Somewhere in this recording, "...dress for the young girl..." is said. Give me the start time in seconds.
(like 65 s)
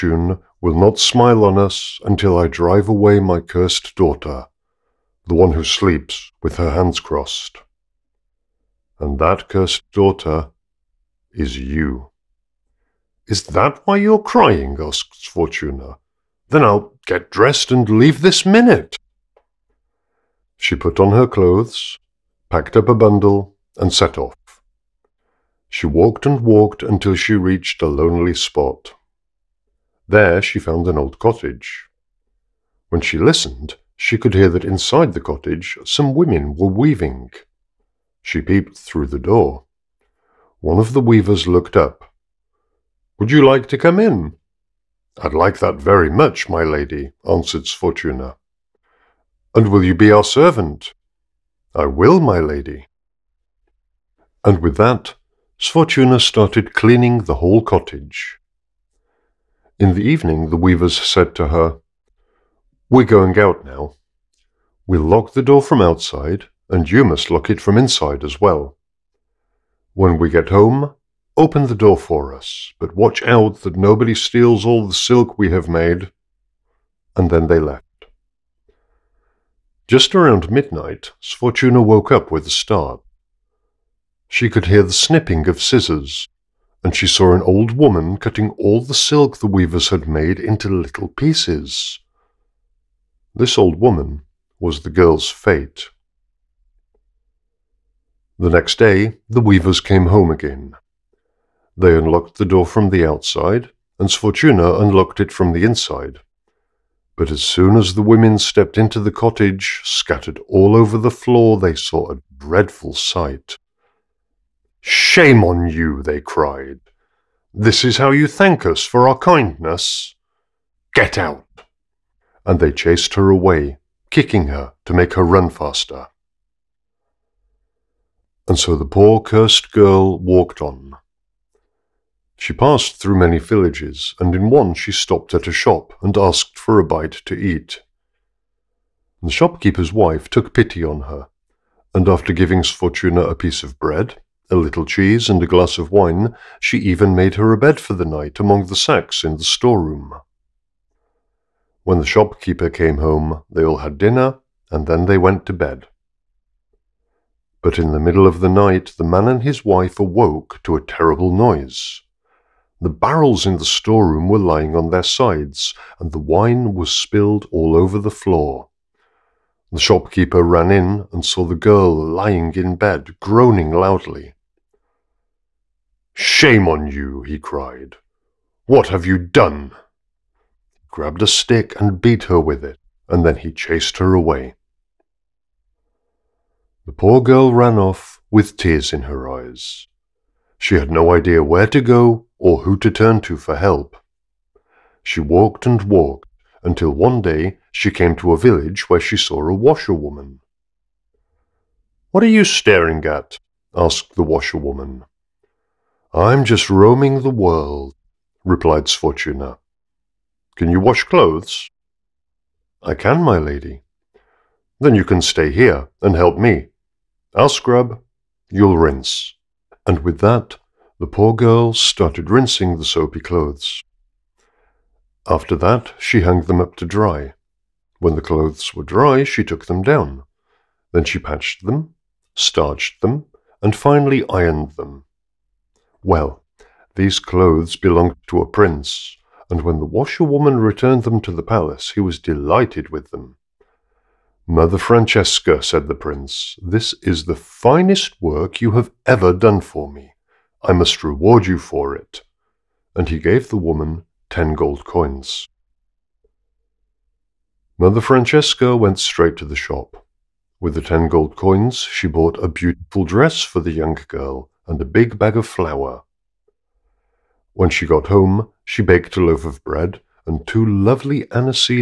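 263 s.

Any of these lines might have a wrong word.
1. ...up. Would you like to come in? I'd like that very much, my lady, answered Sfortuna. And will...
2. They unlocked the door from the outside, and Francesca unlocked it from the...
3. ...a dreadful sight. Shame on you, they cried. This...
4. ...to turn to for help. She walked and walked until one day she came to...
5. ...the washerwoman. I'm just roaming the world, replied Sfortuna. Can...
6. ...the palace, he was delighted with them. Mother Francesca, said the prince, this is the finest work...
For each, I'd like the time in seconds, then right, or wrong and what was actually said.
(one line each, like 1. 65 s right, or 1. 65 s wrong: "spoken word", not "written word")
1. 41 s right
2. 101 s wrong: "Sfortuna", not "Francesca"
3. 112 s right
4. 192 s right
5. 204 s right
6. 241 s right.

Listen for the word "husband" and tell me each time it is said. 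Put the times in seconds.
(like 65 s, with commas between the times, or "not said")
not said.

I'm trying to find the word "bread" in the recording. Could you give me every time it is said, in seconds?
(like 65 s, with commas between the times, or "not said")
143 s, 269 s.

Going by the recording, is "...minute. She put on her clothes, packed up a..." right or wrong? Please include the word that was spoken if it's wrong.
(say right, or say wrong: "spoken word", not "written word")
right.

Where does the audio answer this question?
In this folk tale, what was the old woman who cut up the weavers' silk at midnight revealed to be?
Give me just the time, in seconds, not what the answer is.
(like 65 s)
94 s.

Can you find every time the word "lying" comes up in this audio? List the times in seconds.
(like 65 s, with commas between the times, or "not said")
164 s, 171 s.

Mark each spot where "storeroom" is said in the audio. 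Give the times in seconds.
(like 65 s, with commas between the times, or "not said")
149 s, 163 s.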